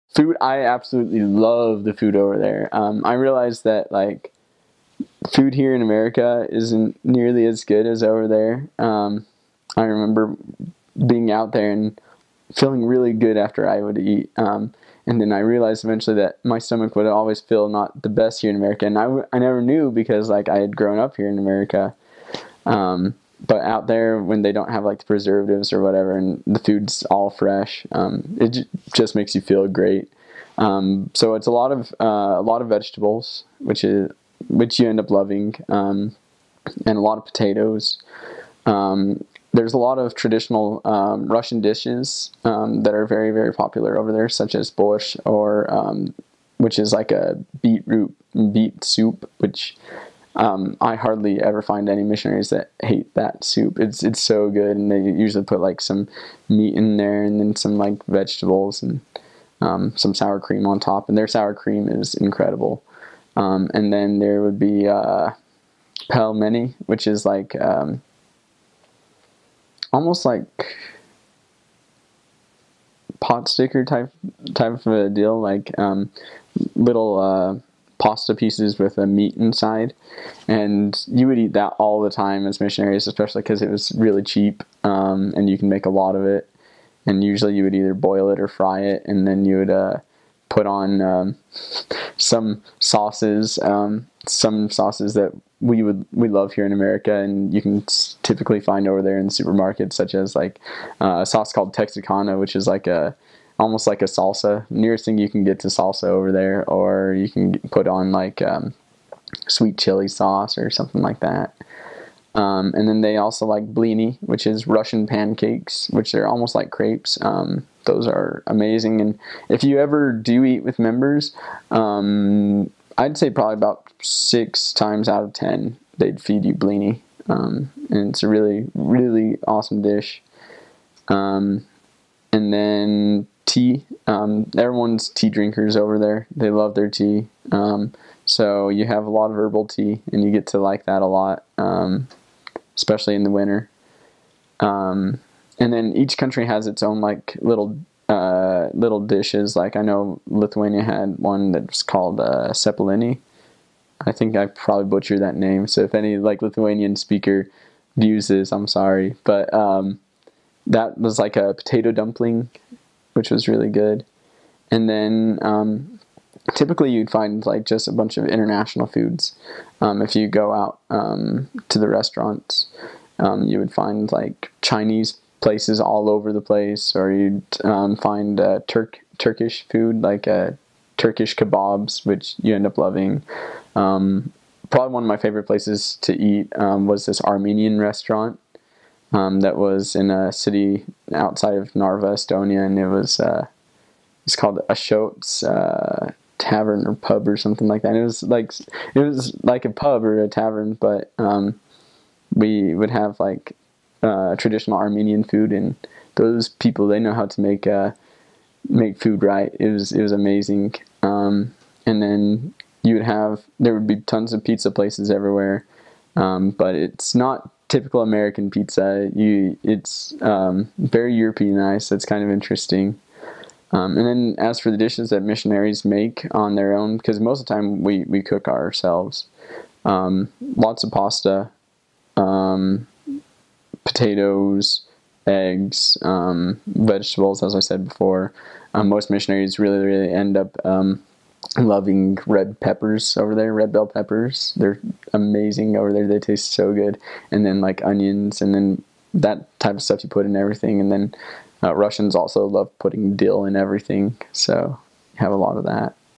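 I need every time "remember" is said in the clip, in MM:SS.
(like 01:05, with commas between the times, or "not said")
00:09.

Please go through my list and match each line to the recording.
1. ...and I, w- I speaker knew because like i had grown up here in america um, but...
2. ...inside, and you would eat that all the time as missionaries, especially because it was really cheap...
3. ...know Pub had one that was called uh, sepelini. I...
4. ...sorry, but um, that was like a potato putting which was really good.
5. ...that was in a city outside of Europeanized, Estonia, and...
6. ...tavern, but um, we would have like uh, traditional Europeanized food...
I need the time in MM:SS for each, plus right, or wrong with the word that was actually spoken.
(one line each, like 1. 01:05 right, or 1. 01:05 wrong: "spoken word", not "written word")
1. 00:18 wrong: "never", not "speaker"
2. 01:19 right
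3. 02:29 wrong: "Lithuania", not "Pub"
4. 02:38 wrong: "dumpling", not "putting"
5. 03:09 wrong: "Narva", not "Europeanized"
6. 03:20 wrong: "Armenian", not "Europeanized".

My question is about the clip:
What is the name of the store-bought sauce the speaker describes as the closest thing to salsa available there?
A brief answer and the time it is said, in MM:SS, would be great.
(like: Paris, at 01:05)
Texicana, at 01:41.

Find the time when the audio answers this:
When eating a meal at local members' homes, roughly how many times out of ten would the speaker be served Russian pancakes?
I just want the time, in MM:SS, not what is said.
02:04.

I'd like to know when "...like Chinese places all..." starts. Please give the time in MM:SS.
02:54.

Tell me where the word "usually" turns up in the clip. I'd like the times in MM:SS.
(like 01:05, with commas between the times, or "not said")
00:55, 01:27.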